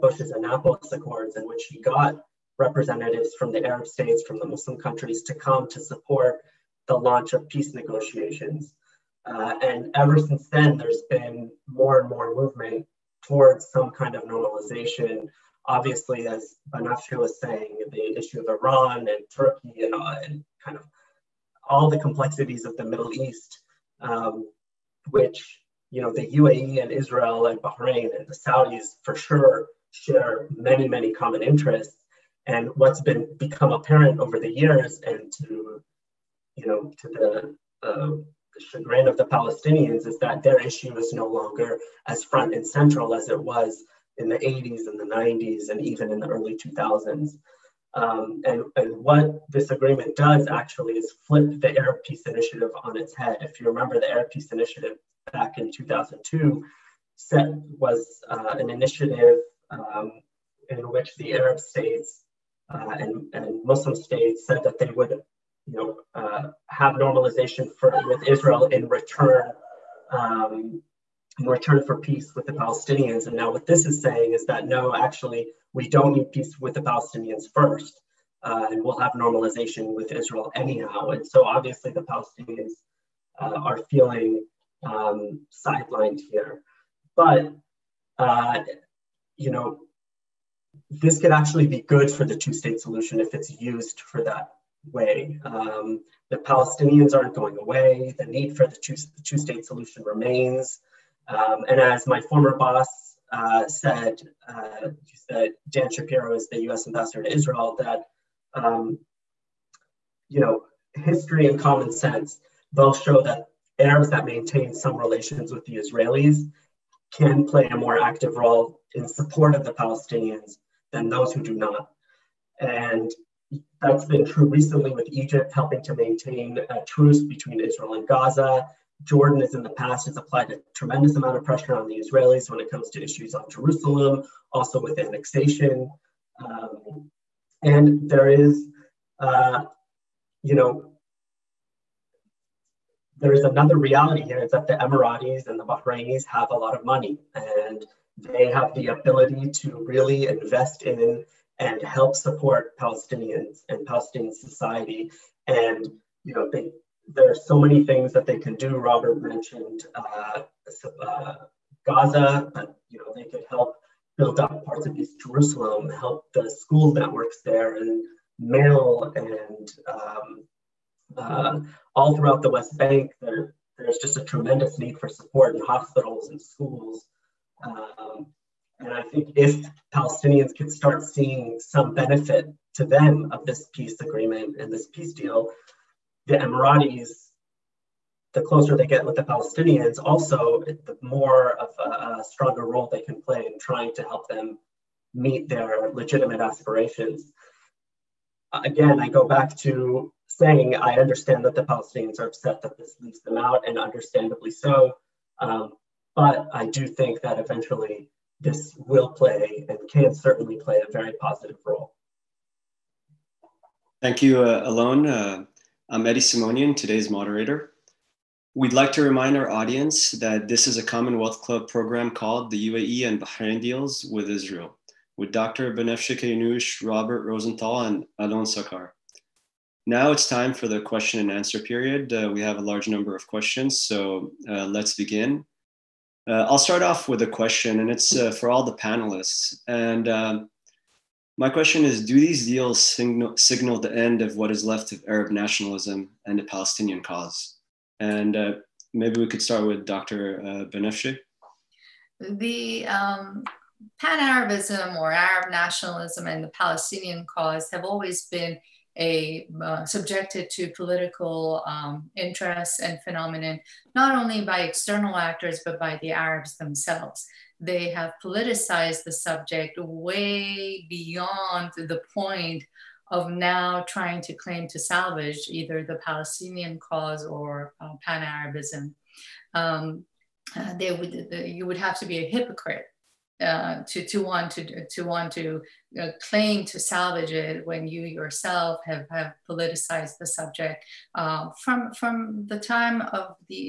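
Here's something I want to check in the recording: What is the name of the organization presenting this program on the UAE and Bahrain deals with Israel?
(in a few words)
Commonwealth Club.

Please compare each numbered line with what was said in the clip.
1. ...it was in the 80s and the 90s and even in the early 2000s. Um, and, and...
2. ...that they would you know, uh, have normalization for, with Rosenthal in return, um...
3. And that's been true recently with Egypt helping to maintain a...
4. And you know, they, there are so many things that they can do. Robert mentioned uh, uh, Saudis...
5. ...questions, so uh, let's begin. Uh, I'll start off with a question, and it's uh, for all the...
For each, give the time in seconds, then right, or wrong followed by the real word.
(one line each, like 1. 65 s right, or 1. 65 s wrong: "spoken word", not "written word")
1. 43 s right
2. 64 s wrong: "Israel", not "Rosenthal"
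3. 122 s right
4. 155 s wrong: "Gaza", not "Saudis"
5. 233 s right.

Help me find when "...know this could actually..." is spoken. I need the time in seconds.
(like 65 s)
89 s.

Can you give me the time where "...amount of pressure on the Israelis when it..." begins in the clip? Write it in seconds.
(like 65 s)
131 s.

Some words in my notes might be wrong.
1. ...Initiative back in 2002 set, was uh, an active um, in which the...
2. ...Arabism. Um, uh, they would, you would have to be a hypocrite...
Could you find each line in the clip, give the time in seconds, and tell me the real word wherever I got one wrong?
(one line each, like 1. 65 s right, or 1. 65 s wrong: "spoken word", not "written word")
1. 54 s wrong: "initiative", not "active"
2. 278 s right.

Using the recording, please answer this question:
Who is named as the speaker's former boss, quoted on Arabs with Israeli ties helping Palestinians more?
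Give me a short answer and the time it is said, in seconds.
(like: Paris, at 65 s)
Dan Shapiro, at 105 s.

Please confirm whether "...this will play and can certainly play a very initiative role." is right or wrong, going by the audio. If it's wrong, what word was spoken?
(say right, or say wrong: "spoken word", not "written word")
wrong: "positive", not "initiative".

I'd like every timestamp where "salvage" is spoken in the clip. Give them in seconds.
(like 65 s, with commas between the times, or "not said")
274 s, 286 s.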